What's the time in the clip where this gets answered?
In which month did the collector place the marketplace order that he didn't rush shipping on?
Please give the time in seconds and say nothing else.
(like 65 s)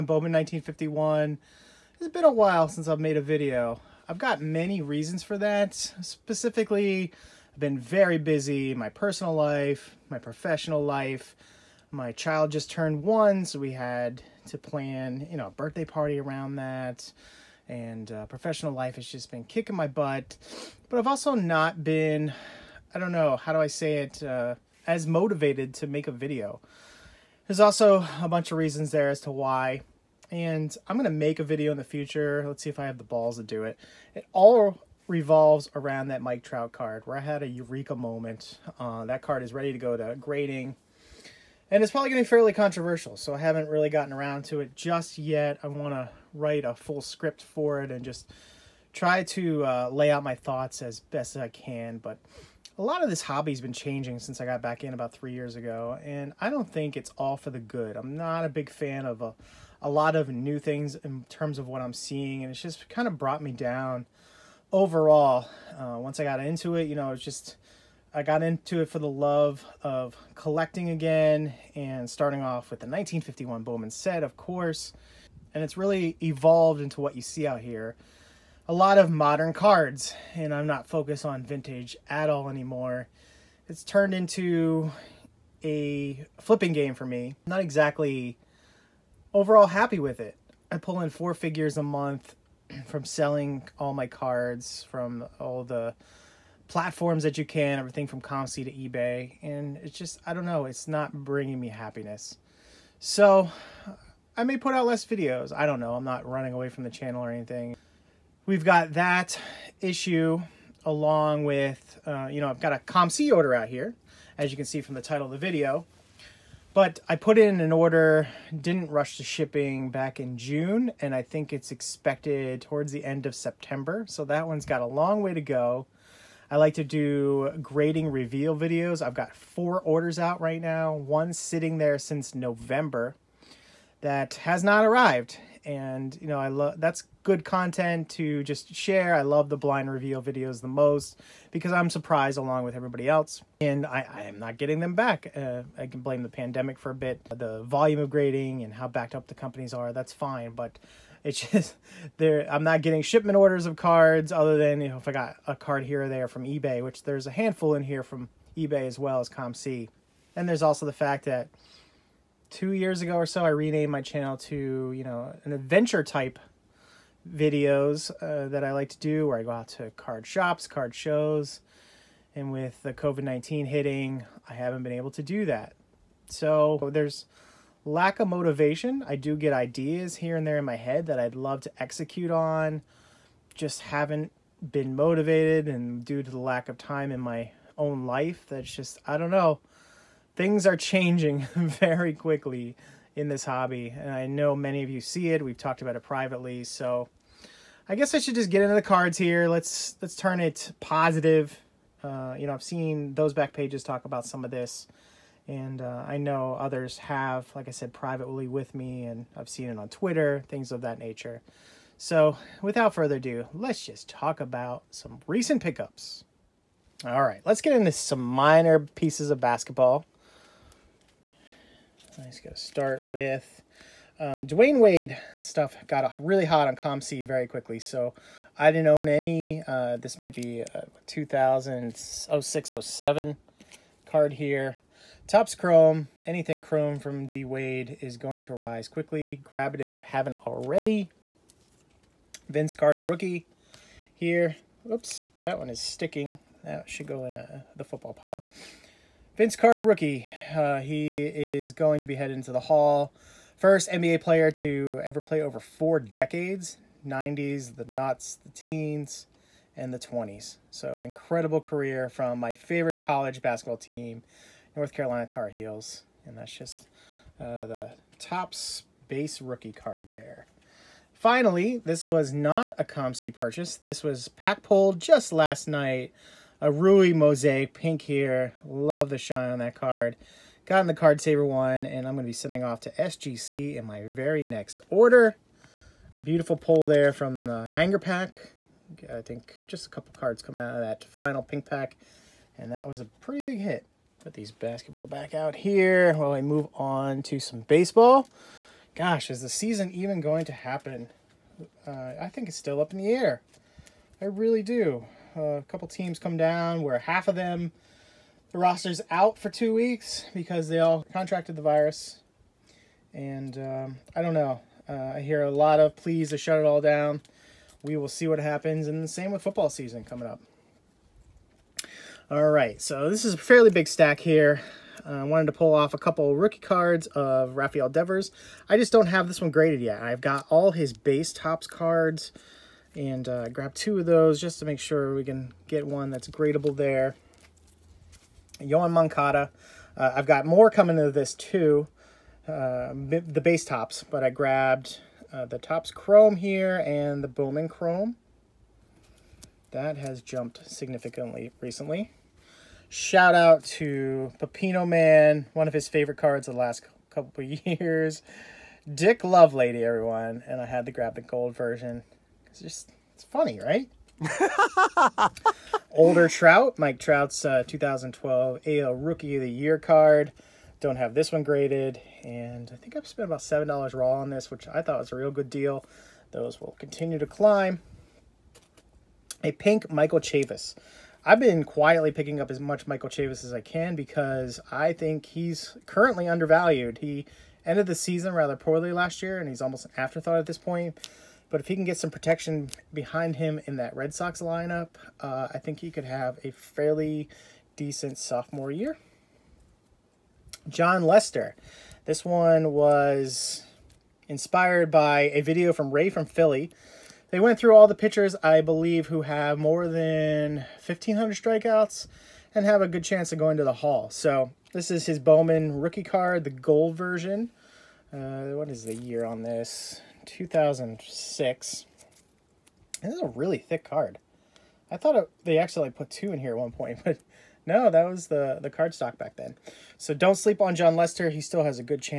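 120 s.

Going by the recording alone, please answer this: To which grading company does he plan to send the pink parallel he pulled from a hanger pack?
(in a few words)
SGC.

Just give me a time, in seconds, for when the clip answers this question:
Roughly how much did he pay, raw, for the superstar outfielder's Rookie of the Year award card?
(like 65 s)
373 s.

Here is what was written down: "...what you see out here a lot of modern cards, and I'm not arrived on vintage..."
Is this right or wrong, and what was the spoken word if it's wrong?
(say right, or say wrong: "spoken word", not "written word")
wrong: "focused", not "arrived".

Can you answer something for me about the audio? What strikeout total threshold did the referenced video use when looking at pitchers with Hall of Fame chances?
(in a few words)
1,500.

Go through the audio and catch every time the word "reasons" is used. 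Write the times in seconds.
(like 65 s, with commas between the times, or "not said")
4 s, 28 s.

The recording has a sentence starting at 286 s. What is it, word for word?
Beautiful pull there from the hanger pack.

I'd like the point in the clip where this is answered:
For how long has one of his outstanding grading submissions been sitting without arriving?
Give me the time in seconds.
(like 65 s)
131 s.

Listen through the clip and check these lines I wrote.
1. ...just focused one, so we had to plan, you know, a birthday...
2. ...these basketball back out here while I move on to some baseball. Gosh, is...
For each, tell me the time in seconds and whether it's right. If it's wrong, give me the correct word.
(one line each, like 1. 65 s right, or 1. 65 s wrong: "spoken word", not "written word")
1. 12 s wrong: "turned", not "focused"
2. 294 s right.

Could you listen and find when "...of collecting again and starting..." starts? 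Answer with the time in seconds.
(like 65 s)
69 s.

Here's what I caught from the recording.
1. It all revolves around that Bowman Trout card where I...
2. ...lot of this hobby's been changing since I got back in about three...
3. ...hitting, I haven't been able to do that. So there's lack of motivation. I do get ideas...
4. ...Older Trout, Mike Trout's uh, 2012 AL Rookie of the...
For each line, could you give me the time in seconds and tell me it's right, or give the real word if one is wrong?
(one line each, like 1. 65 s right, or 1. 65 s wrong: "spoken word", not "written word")
1. 34 s wrong: "Mike", not "Bowman"
2. 52 s right
3. 173 s right
4. 365 s right.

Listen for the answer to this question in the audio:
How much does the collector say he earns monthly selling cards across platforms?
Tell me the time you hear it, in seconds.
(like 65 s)
91 s.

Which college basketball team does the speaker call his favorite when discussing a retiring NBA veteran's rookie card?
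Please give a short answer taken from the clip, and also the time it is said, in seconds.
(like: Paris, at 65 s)
North Carolina Tar Heels, at 264 s.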